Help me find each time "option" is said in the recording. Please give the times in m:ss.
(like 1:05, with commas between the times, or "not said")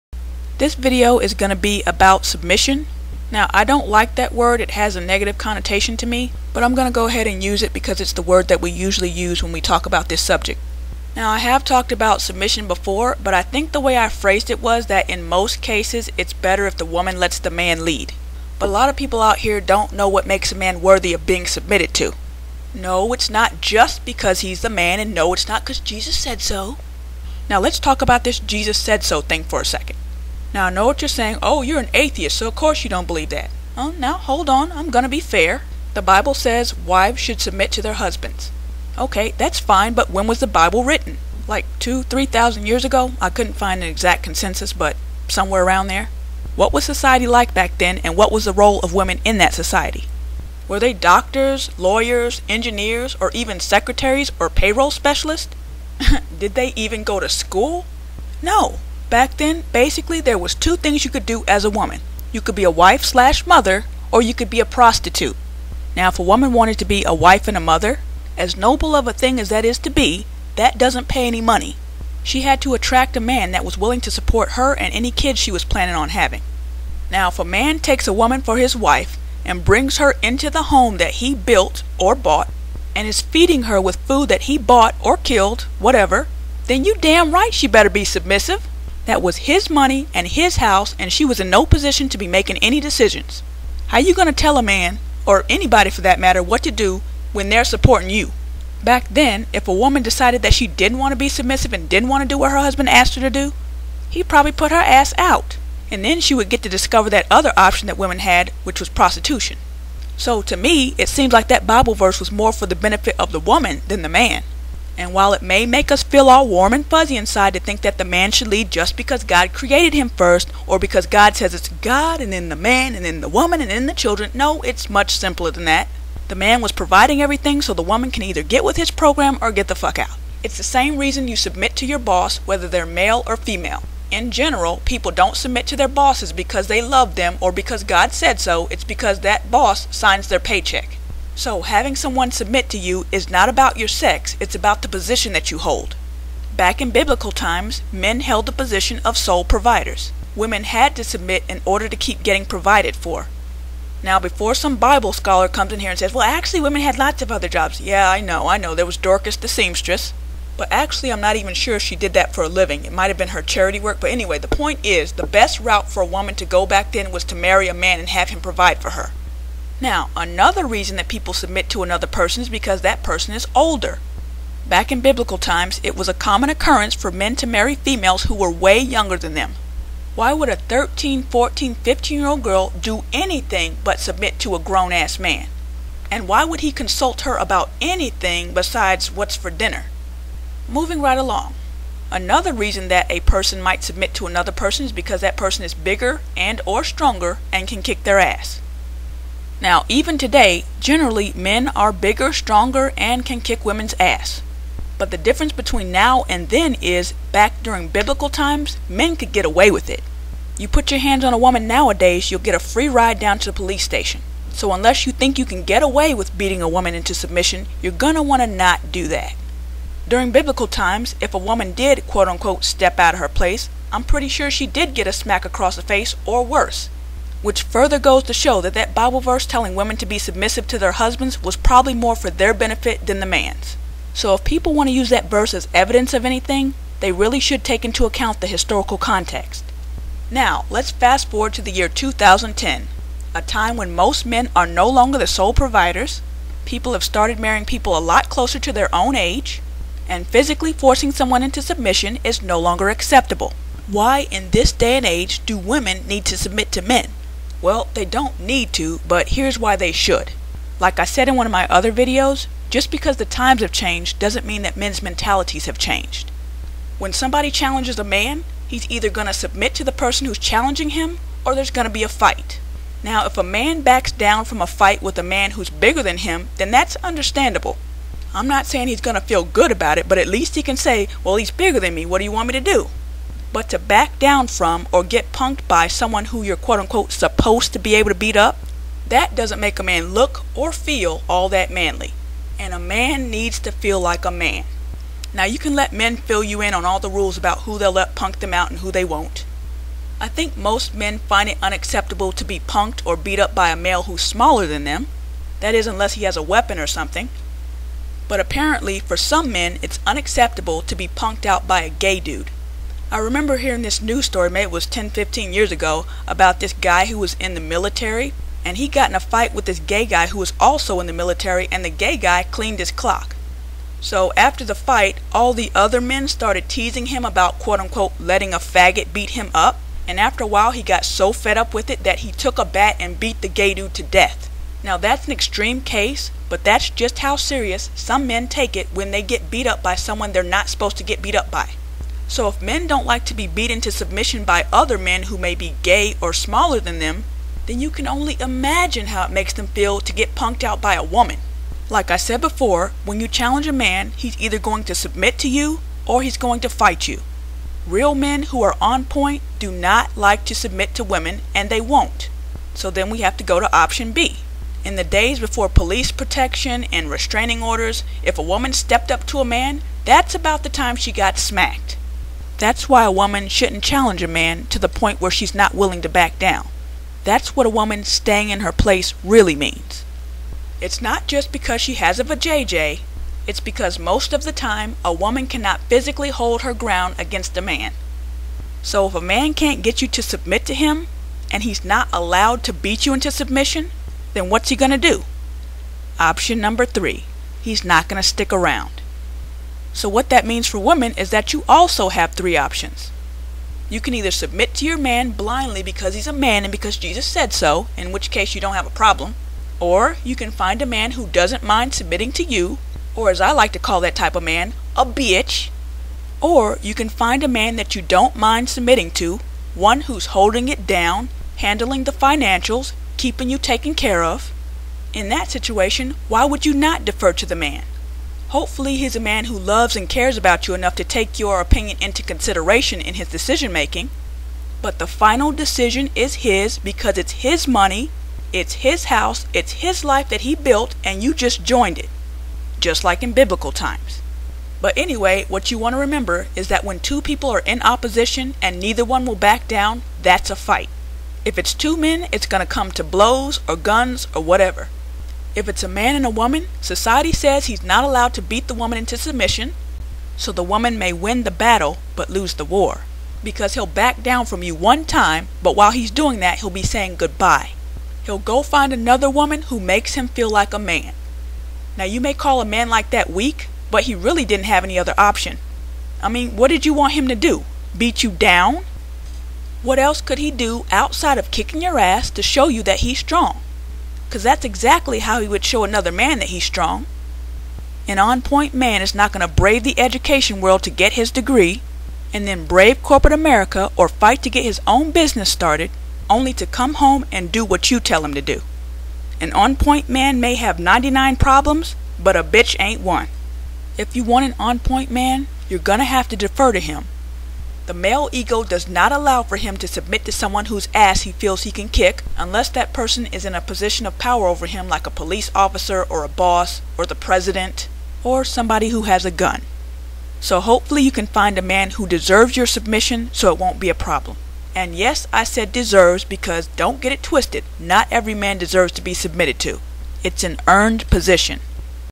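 1:47, 6:03, 6:36, 6:42, 7:55.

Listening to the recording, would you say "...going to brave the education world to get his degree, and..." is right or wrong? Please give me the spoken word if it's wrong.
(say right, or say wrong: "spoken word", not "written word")
right.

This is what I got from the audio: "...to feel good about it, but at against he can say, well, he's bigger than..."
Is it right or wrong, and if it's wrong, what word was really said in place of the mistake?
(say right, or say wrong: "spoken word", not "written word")
wrong: "least", not "against".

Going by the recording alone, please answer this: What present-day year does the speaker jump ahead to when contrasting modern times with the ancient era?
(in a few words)
2010.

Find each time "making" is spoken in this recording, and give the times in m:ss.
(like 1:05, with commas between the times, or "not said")
1:32, 7:13.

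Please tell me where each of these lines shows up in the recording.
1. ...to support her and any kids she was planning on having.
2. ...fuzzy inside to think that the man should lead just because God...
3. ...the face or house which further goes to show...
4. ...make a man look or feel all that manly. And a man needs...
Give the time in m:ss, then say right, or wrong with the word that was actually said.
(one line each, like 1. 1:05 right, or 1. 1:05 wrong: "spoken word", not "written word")
1. 1:13 right
2. 1:56 right
3. 3:45 wrong: "worse", not "house"
4. 4:49 right.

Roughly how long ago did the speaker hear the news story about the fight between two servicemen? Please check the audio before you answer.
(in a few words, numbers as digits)
10 to 15 years ago.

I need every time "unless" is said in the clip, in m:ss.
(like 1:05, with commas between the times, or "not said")
3:34, 5:05, 8:32.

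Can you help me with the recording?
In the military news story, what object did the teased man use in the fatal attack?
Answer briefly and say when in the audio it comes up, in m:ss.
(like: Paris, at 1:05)
a bat, at 5:32.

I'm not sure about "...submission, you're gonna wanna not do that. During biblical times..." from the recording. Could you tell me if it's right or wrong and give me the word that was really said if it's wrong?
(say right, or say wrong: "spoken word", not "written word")
right.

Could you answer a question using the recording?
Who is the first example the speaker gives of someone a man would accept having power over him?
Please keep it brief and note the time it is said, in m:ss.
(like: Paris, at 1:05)
police officer, at 8:35.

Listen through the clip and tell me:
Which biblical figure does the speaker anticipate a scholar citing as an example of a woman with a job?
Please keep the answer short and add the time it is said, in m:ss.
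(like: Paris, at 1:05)
Dorcas, at 2:38.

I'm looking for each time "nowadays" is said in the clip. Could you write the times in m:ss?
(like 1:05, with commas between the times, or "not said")
3:31.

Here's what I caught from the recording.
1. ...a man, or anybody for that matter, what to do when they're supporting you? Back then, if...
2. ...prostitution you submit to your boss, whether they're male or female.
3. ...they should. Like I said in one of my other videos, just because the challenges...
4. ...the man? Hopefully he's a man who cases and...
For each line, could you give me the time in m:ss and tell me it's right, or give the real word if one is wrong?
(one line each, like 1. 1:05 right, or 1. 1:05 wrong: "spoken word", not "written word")
1. 1:34 right
2. 2:10 wrong: "reason", not "prostitution"
3. 4:19 wrong: "times", not "challenges"
4. 7:07 wrong: "loves", not "cases".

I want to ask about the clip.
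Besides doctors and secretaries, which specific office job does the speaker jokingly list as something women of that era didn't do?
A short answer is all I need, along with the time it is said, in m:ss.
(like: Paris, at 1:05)
payroll specialists, at 0:54.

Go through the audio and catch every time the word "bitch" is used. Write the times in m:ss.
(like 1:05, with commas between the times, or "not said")
6:55, 8:22.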